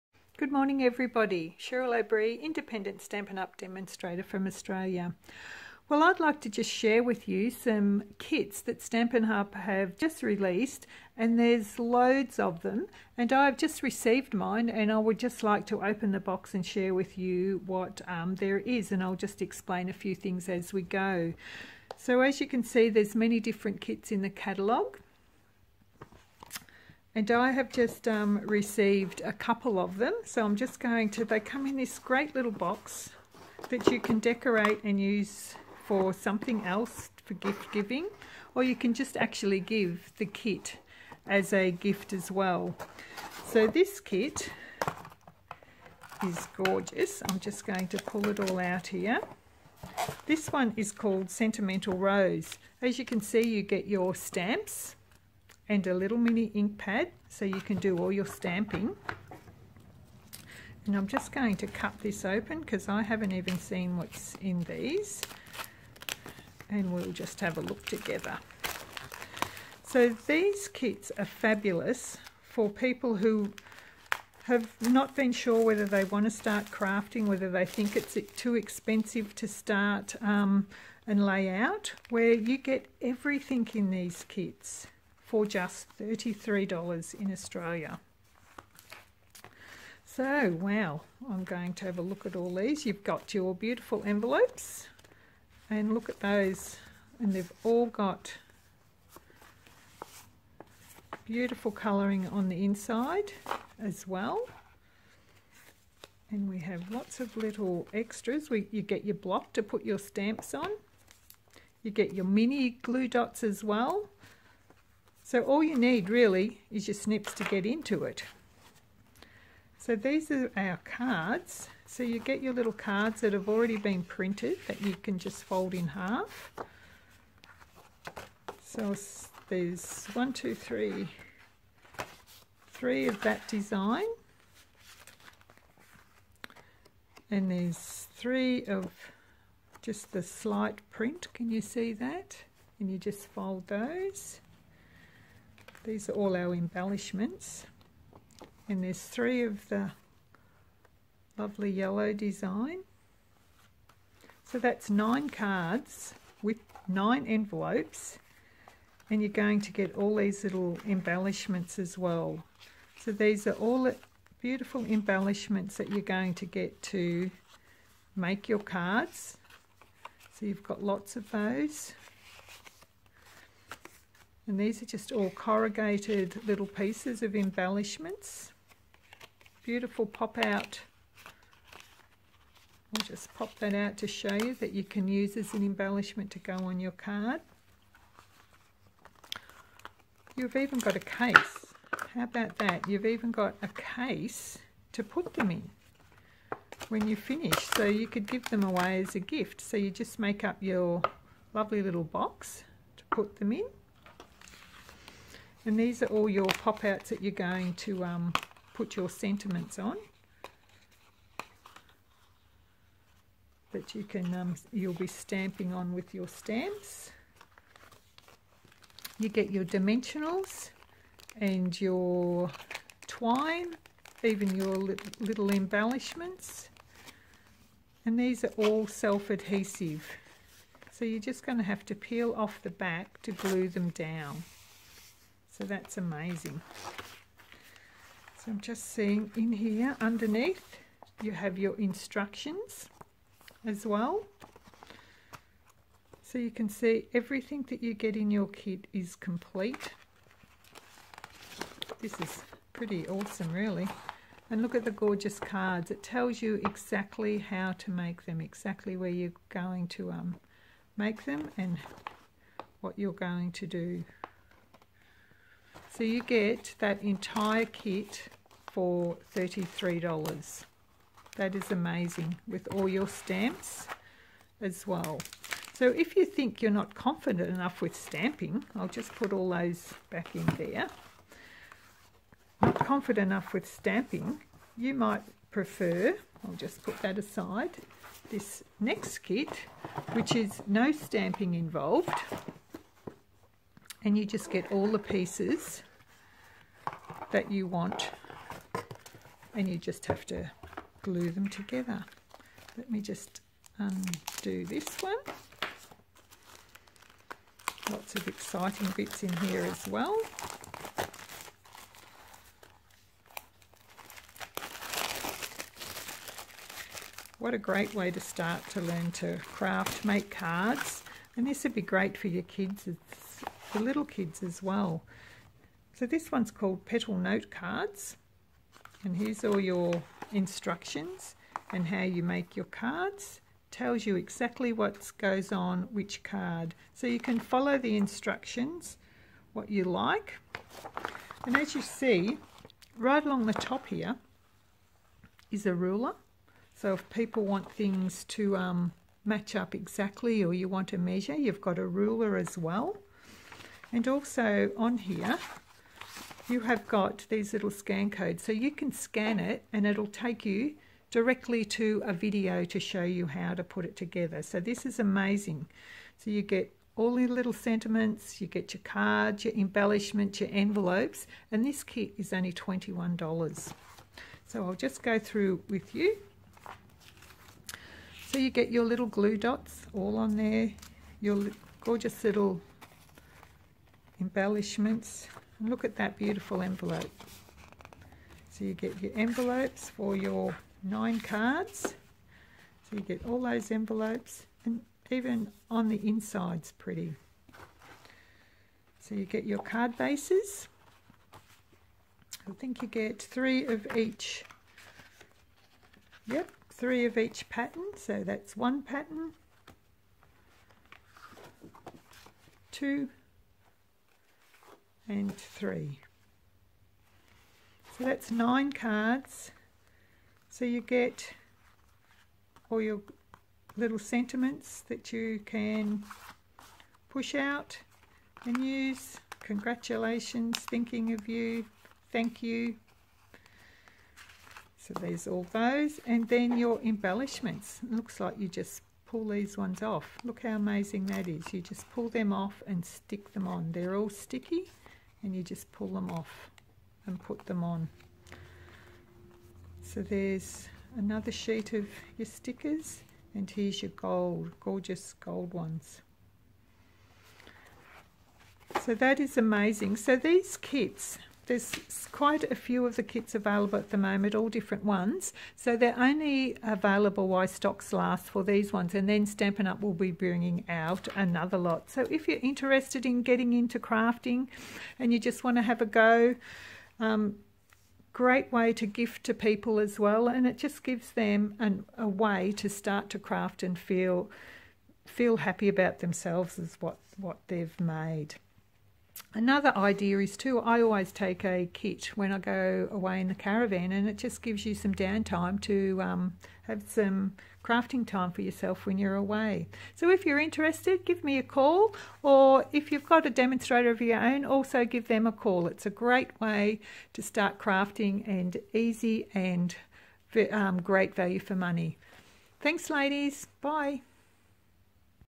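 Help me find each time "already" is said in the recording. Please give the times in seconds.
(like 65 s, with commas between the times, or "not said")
123 s.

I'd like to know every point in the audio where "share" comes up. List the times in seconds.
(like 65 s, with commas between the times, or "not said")
6 s, 16 s.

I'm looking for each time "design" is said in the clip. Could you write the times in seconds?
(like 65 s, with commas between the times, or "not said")
133 s, 152 s.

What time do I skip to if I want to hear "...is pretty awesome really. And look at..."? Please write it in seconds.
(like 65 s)
252 s.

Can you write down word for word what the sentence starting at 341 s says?
And as you see, right along the top here is a ruler.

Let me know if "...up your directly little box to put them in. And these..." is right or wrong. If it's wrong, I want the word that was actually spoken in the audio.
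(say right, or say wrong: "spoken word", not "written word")
wrong: "lovely", not "directly".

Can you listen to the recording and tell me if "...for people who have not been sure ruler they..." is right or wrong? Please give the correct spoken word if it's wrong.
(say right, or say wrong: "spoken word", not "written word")
wrong: "whether", not "ruler".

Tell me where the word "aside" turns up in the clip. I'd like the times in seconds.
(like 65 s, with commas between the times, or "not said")
287 s.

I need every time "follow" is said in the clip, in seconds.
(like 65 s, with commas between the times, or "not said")
337 s.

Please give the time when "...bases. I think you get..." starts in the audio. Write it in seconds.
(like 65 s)
399 s.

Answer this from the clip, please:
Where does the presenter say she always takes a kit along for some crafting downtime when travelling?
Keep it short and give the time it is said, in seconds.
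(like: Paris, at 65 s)
the caravan, at 493 s.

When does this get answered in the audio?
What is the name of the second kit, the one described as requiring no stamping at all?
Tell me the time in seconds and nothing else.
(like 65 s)
326 s.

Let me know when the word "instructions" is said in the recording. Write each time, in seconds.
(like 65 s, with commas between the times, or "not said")
241 s, 330 s, 337 s.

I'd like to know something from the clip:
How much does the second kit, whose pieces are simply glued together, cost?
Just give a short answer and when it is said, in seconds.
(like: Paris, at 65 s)
$21, at 372 s.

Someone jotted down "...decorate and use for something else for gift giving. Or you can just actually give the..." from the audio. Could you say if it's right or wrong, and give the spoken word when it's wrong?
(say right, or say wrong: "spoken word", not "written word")
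right.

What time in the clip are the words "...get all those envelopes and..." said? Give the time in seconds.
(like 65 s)
393 s.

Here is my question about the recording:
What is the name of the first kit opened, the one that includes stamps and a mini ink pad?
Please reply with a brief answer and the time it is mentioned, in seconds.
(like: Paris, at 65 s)
Sentimental Rose, at 51 s.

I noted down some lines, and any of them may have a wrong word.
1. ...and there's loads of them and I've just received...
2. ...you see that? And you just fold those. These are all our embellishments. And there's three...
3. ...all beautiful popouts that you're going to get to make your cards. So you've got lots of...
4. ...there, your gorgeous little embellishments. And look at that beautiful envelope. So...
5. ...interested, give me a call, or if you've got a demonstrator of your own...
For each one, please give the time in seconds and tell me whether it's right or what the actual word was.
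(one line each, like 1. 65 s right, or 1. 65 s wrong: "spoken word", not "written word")
1. 11 s right
2. 141 s right
3. 163 s wrong: "embellishments", not "popouts"
4. 380 s right
5. 500 s right.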